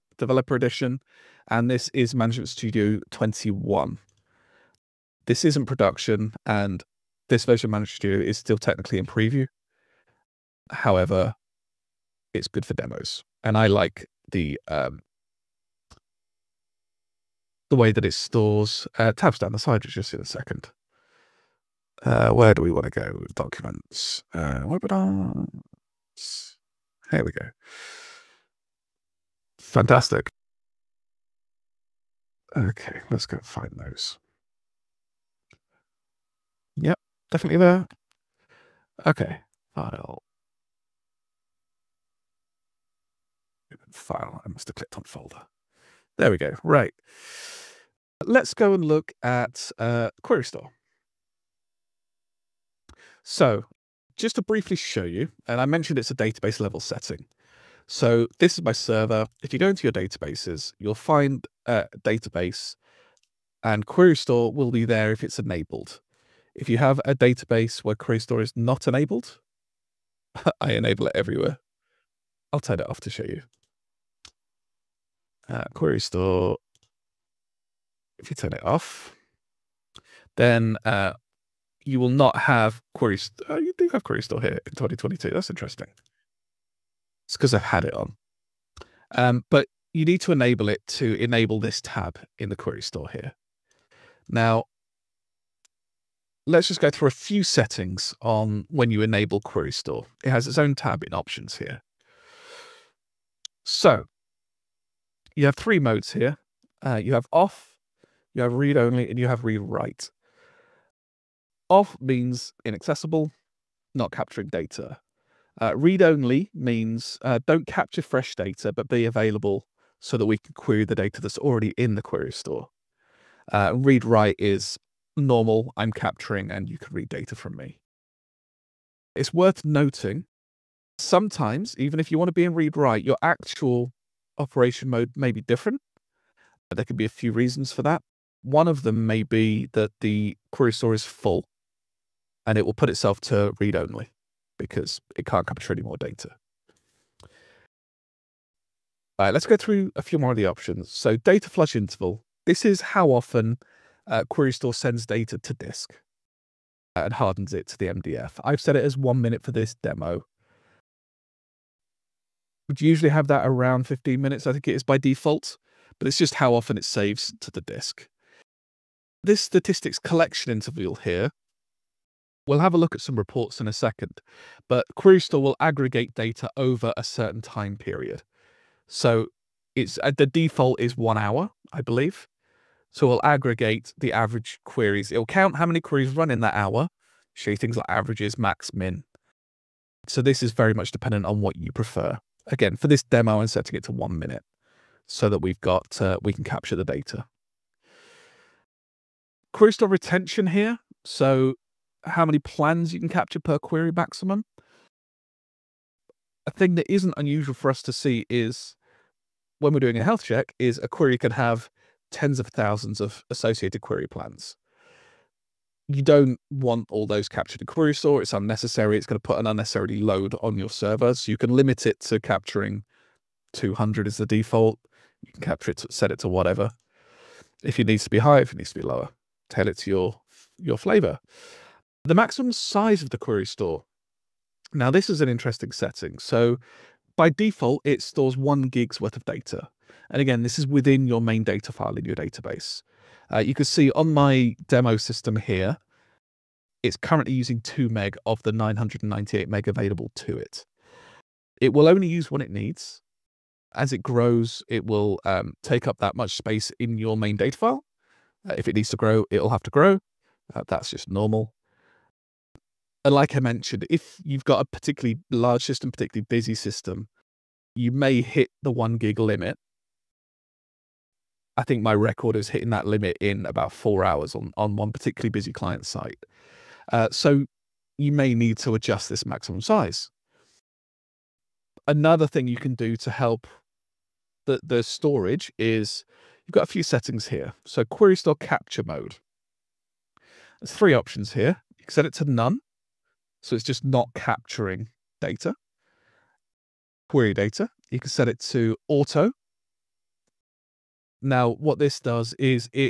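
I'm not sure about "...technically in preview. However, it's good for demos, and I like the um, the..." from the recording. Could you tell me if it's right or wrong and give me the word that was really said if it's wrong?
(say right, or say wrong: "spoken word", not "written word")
right.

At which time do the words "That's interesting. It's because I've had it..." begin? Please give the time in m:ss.
1:25.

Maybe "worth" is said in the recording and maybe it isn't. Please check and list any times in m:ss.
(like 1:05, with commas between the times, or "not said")
2:09, 3:58.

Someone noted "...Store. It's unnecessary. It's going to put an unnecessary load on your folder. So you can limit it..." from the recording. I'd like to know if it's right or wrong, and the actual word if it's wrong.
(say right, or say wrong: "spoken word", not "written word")
wrong: "server", not "folder".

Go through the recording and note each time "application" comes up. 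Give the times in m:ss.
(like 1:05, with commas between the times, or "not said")
not said.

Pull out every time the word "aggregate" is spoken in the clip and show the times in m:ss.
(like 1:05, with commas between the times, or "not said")
2:55, 3:03.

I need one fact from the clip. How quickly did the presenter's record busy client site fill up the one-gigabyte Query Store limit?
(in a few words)
about 4 hours.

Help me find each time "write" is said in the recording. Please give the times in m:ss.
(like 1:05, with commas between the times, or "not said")
1:49, 2:04, 2:12.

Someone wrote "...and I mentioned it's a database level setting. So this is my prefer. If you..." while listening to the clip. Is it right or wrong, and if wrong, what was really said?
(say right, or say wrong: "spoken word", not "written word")
wrong: "server", not "prefer".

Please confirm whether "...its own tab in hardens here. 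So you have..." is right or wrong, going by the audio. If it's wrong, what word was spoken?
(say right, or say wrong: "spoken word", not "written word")
wrong: "options", not "hardens".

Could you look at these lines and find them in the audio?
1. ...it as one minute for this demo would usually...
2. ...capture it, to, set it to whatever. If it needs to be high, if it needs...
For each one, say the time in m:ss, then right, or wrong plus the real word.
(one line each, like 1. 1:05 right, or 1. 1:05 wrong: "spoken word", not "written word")
1. 2:38 right
2. 3:45 right.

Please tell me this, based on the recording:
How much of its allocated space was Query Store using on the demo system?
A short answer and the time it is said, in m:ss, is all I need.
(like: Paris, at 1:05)
2 MB, at 4:07.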